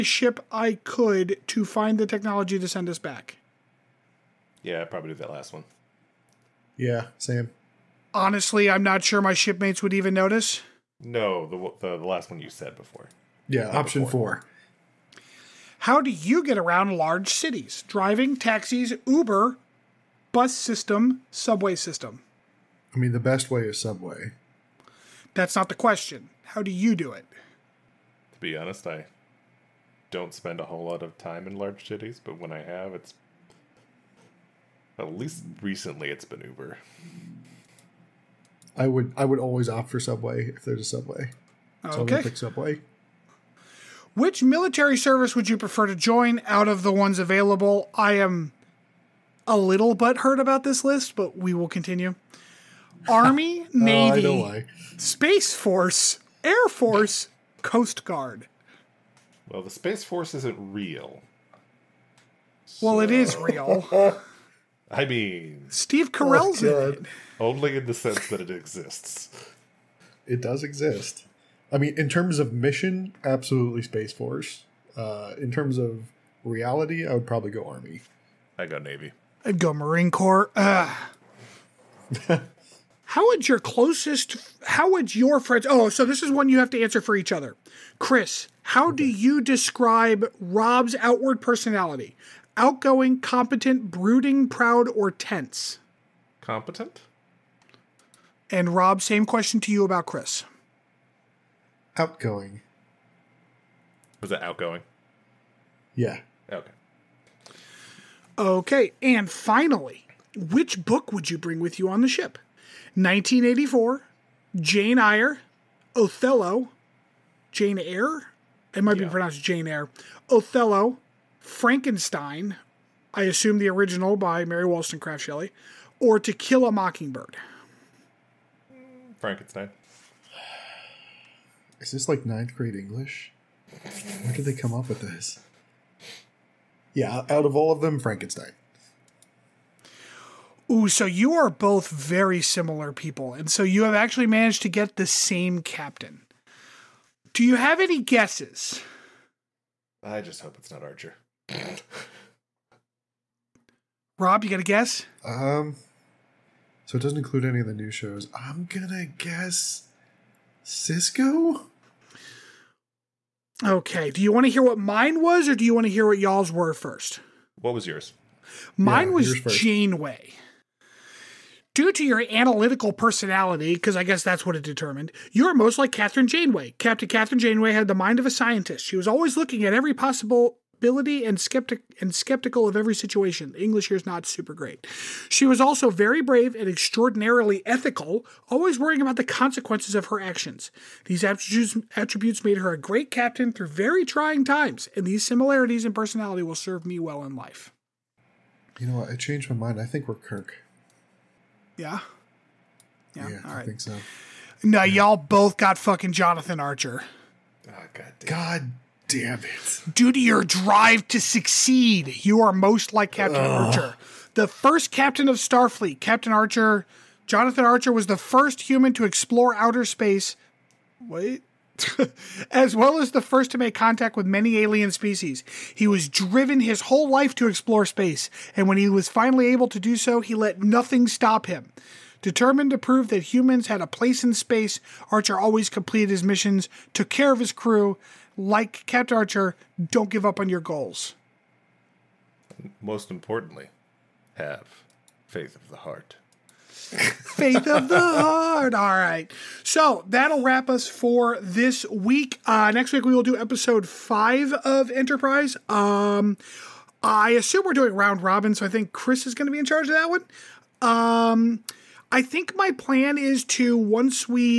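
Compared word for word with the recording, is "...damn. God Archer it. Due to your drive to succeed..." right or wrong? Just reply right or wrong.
wrong.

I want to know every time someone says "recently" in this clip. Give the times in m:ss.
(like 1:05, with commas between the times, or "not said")
0:35.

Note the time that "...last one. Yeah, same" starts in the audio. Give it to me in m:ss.
0:05.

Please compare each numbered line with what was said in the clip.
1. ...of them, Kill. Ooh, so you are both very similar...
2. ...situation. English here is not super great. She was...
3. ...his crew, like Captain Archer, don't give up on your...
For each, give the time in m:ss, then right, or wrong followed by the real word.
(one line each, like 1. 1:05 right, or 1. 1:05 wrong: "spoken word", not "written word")
1. 2:17 wrong: "Frankenstein", not "Kill"
2. 3:02 right
3. 3:57 right.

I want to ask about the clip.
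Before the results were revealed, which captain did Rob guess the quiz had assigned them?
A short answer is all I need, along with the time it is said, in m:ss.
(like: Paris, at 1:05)
Sisko, at 2:38.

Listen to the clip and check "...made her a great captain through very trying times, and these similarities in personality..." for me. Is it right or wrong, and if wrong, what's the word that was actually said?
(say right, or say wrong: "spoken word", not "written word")
right.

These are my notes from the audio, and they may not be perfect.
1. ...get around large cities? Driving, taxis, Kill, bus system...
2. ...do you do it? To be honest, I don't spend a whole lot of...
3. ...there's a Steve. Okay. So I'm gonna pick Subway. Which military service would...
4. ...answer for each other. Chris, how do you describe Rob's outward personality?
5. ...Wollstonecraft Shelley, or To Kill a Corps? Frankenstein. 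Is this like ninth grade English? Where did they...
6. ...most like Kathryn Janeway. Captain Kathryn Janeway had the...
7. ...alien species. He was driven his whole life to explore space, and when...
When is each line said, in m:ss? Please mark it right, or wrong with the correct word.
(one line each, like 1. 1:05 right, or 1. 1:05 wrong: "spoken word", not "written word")
1. 0:16 wrong: "Uber", not "Kill"
2. 0:26 right
3. 0:40 wrong: "Subway", not "Steve"
4. 1:26 right
5. 2:04 wrong: "Mockingbird", not "Corps"
6. 2:55 right
7. 3:44 right.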